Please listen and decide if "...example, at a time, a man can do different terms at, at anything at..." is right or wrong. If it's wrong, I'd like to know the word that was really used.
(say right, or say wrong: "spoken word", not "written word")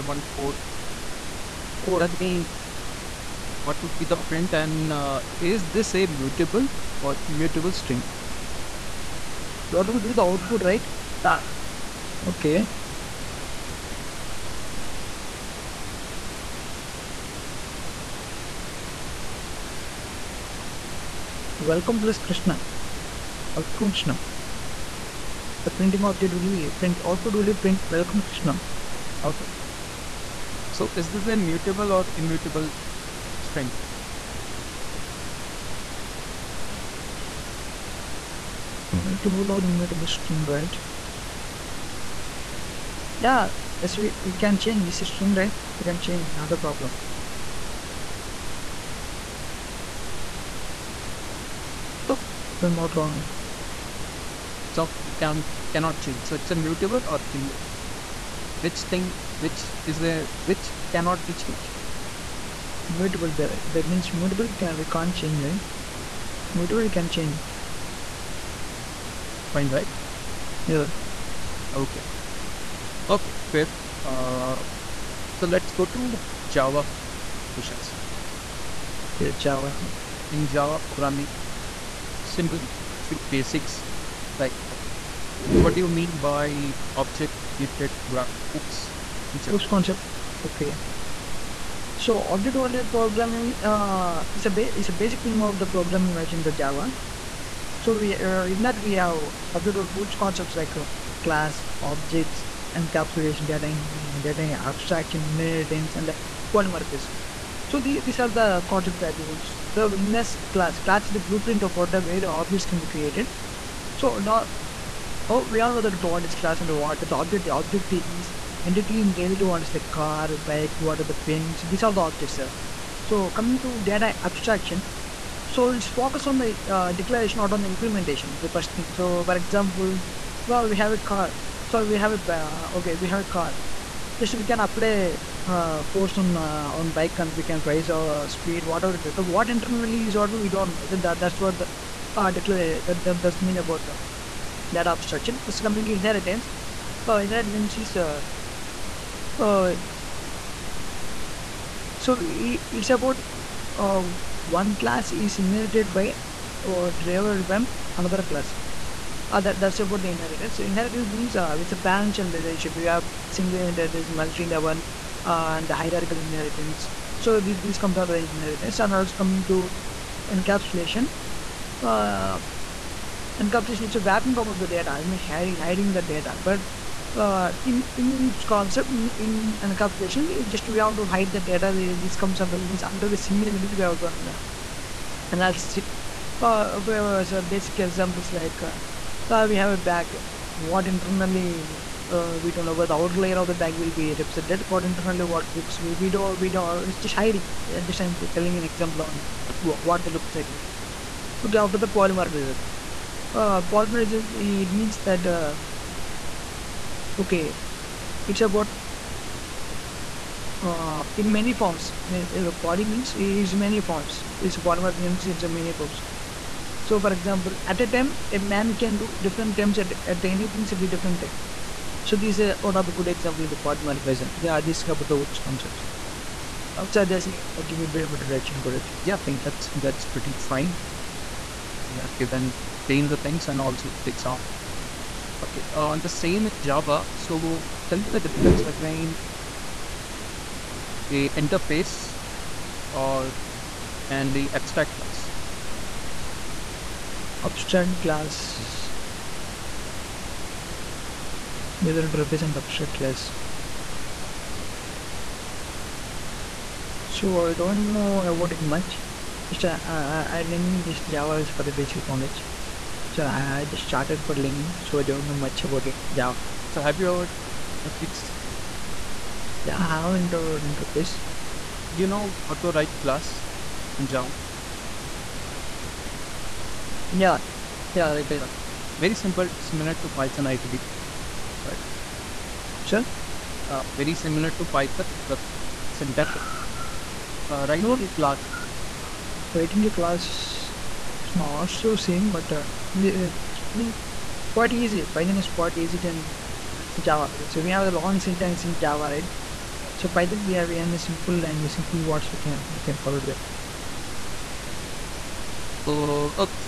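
right.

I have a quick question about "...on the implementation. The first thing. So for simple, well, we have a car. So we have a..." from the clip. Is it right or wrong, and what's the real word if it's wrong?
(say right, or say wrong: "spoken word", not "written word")
wrong: "example", not "simple".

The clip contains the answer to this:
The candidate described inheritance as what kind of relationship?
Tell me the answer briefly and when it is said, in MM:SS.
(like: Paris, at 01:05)
parent-child relationship, at 02:41.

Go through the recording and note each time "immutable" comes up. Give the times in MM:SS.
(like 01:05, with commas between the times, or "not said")
00:07, 00:32, 00:39, 00:57.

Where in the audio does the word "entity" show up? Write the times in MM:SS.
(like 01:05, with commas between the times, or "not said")
01:58.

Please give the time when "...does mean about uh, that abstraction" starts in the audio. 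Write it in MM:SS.
02:23.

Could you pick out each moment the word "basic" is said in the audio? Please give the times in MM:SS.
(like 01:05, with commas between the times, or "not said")
01:23, 01:34, 03:07, 04:21.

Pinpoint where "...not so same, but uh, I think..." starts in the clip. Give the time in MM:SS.
04:51.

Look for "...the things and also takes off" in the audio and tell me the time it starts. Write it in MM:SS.
03:53.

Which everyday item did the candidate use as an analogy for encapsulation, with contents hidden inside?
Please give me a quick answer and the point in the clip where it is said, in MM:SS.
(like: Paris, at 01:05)
a bag, at 03:09.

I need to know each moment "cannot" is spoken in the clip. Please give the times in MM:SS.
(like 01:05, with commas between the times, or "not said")
00:55, 01:00.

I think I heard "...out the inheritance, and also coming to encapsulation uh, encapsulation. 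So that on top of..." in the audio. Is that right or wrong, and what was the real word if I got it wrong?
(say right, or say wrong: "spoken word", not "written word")
right.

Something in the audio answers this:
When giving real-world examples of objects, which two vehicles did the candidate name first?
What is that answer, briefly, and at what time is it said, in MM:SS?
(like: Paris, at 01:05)
car, bike, at 01:59.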